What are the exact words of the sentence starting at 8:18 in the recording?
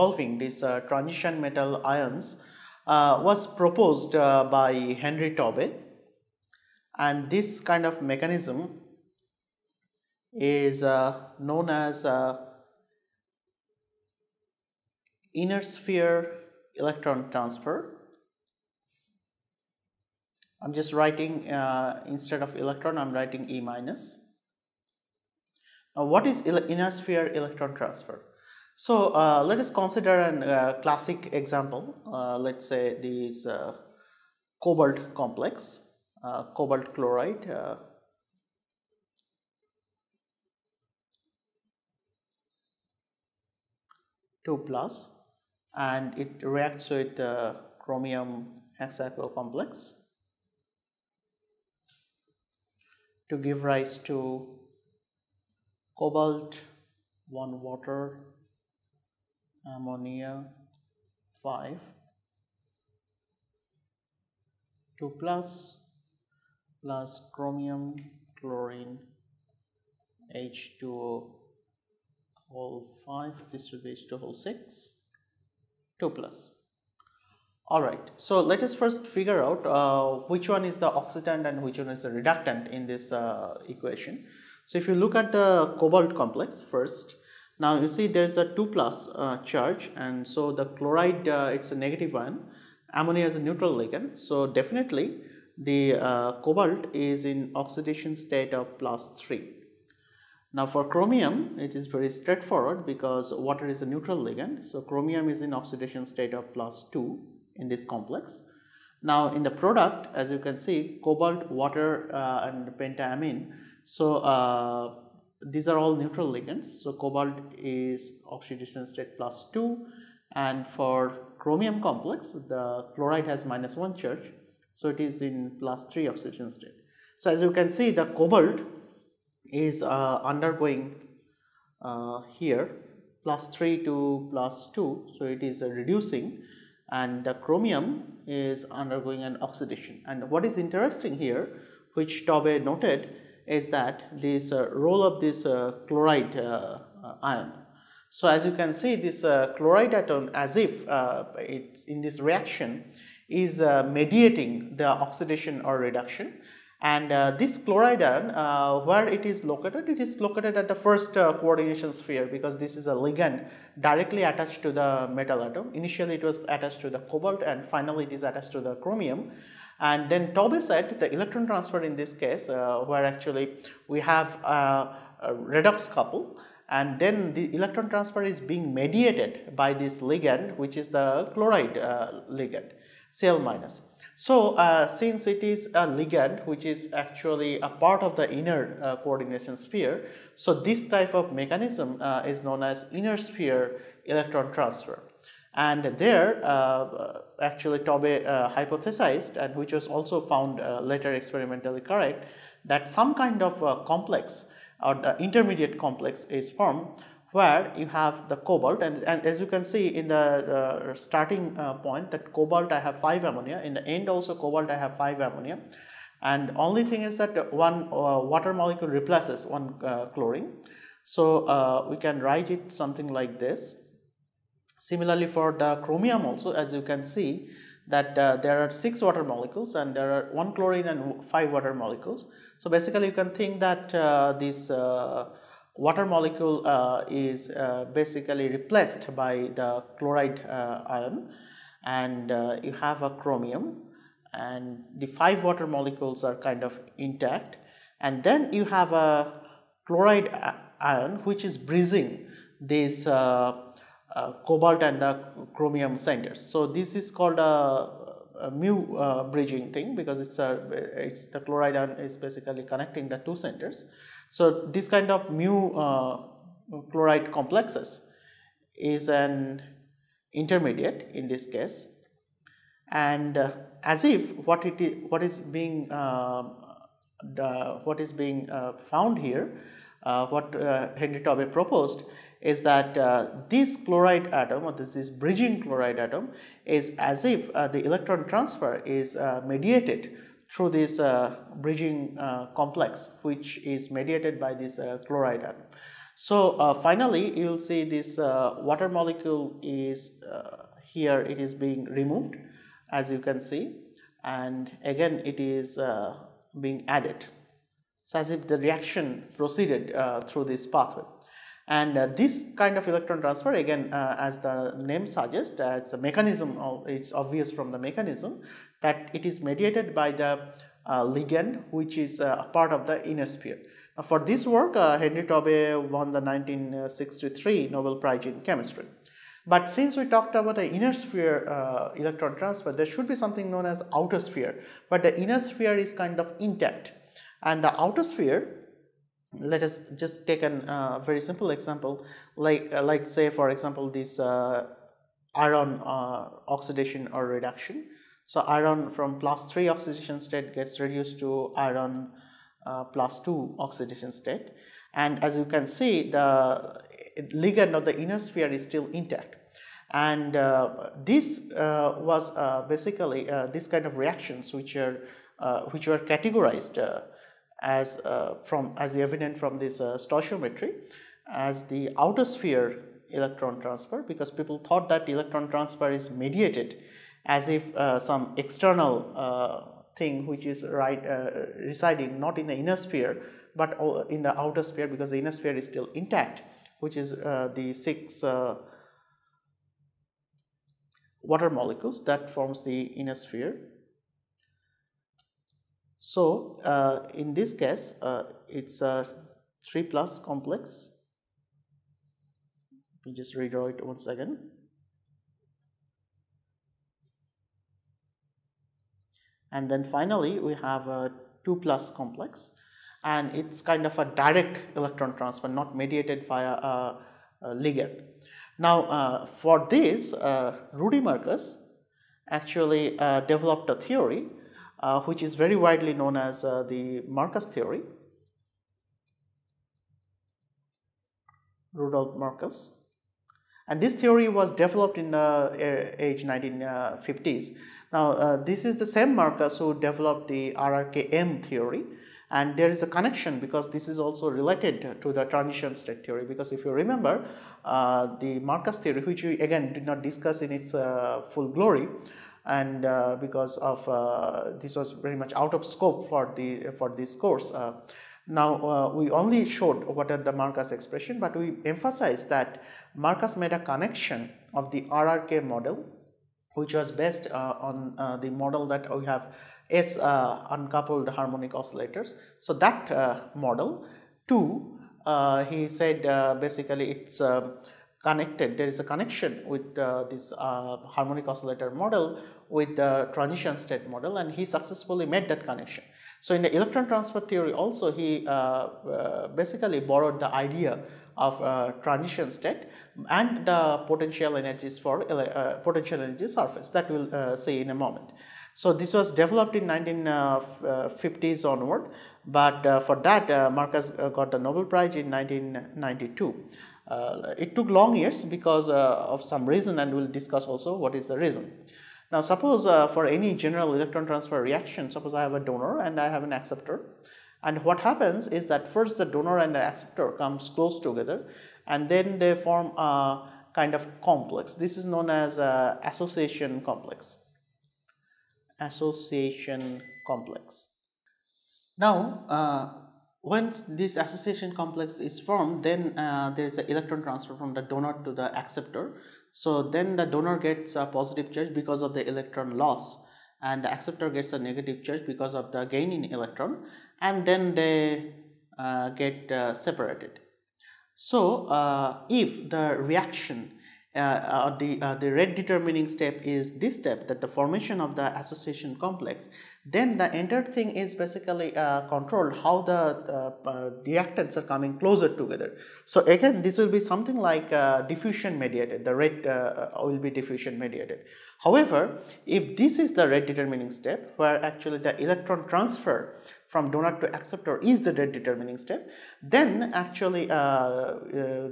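So, this was developed in 1950s onward but for that Marcus got the Nobel Prize in 1992.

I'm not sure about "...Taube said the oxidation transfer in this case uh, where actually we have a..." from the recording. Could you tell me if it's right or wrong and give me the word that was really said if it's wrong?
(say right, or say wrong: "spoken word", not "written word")
wrong: "electron", not "oxidation".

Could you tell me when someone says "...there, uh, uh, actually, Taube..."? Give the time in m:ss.
3:15.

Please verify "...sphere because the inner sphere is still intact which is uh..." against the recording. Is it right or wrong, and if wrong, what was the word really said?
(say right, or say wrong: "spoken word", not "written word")
right.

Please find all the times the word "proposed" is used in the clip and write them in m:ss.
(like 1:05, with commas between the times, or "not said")
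0:03, 4:41.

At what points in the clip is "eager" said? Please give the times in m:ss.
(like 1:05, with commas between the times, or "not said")
not said.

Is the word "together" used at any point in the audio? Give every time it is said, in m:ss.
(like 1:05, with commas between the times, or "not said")
8:40, 9:25.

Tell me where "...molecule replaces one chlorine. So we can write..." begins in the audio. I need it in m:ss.
3:38.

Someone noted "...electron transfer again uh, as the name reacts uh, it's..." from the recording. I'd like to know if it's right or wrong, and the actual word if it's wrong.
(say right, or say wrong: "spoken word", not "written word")
wrong: "suggests", not "reacts".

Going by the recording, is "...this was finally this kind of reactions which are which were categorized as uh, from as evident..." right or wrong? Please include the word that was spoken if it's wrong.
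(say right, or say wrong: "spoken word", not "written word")
wrong: "basically", not "finally".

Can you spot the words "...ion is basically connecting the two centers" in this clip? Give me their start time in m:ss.
4:21.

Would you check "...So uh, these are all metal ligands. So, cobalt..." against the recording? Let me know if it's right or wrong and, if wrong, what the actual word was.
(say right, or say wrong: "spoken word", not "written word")
wrong: "neutral", not "metal".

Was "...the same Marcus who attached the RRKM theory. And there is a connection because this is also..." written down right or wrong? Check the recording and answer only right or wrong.
wrong.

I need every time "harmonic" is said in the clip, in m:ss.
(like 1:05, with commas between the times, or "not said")
7:51, 8:00.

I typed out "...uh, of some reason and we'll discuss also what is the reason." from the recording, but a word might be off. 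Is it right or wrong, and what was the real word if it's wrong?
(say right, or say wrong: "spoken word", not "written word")
right.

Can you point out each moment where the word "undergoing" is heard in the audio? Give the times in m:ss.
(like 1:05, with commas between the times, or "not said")
2:10, 2:18.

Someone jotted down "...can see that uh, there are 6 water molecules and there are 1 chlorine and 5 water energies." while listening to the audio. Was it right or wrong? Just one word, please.
wrong.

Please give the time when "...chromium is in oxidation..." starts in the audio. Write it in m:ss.
1:44.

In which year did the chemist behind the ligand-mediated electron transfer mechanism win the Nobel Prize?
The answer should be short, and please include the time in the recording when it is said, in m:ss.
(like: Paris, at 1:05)
1963, at 5:26.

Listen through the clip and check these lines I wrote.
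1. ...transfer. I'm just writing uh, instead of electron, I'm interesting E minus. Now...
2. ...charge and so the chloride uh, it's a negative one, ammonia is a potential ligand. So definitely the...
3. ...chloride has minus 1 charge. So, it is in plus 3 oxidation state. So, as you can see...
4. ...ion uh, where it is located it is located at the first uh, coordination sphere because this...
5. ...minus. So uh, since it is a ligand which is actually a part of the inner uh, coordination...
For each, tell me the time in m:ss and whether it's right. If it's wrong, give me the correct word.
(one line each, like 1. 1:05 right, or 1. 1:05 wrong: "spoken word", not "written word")
1. 0:17 wrong: "writing", not "interesting"
2. 1:29 wrong: "neutral", not "potential"
3. 2:02 right
4. 2:38 right
5. 3:03 right.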